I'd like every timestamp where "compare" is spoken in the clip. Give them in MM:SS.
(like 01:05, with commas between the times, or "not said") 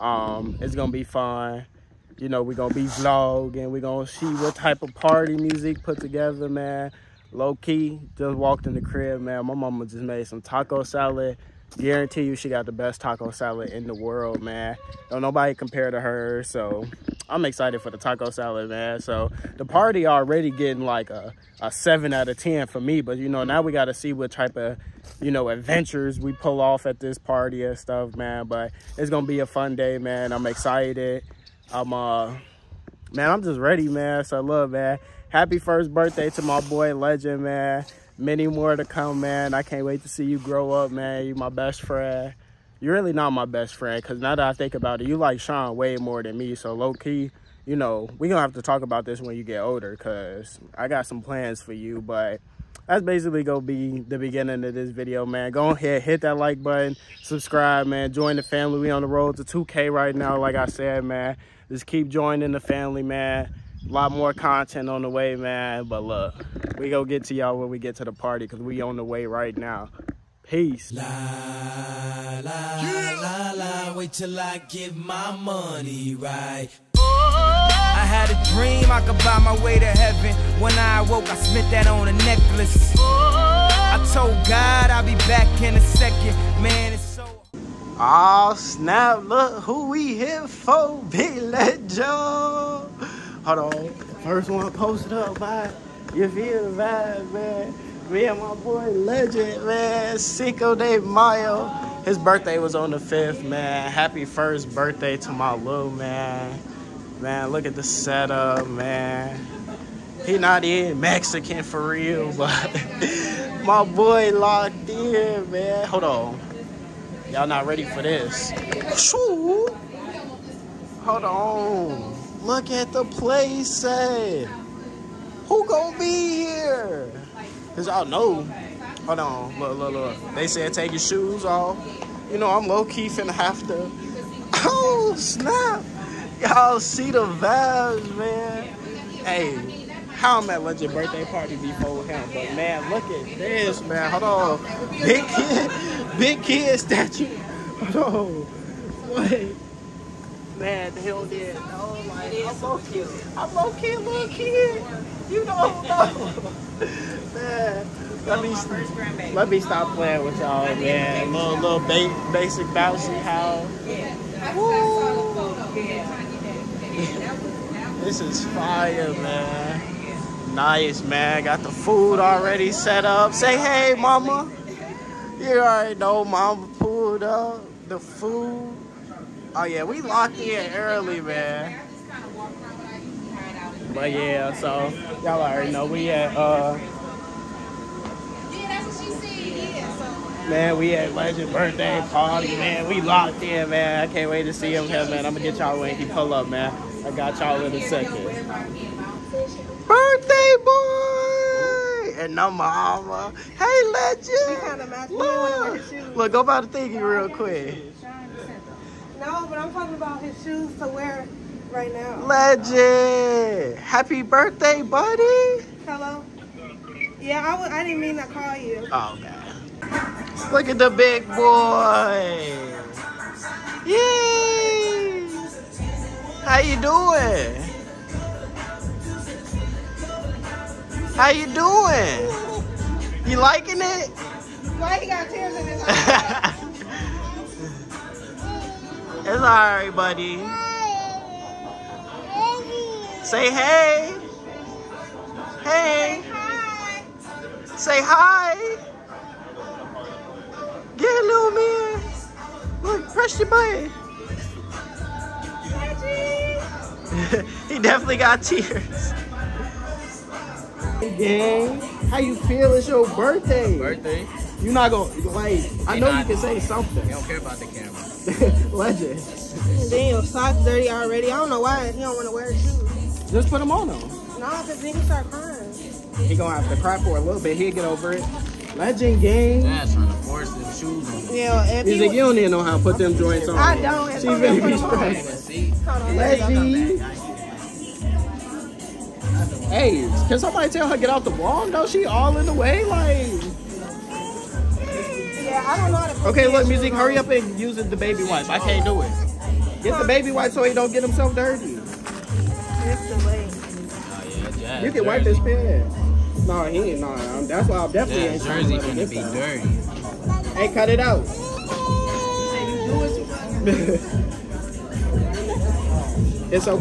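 00:15.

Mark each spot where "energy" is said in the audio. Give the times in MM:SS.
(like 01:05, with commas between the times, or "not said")
not said.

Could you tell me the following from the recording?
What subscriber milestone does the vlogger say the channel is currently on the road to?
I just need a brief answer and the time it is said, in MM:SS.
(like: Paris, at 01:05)
2k, at 00:59.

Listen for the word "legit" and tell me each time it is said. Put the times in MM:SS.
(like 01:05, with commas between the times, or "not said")
02:20.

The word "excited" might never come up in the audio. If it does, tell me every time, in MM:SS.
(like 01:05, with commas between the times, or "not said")
00:17, 00:30.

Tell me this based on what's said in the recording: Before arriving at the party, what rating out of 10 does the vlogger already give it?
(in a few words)
7.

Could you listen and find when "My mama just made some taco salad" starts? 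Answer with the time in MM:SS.
00:09.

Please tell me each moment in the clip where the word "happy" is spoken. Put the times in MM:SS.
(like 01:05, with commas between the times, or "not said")
00:35, 01:43, 03:33.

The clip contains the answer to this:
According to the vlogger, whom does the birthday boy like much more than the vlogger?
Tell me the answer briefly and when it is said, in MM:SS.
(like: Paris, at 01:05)
Sean, at 00:45.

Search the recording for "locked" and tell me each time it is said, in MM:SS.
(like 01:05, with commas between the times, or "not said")
01:54, 03:00, 03:13.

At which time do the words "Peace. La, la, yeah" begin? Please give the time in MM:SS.
01:10.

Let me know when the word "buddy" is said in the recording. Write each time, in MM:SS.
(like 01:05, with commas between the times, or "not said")
03:34, 03:59.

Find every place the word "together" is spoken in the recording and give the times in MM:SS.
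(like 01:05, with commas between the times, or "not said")
00:05.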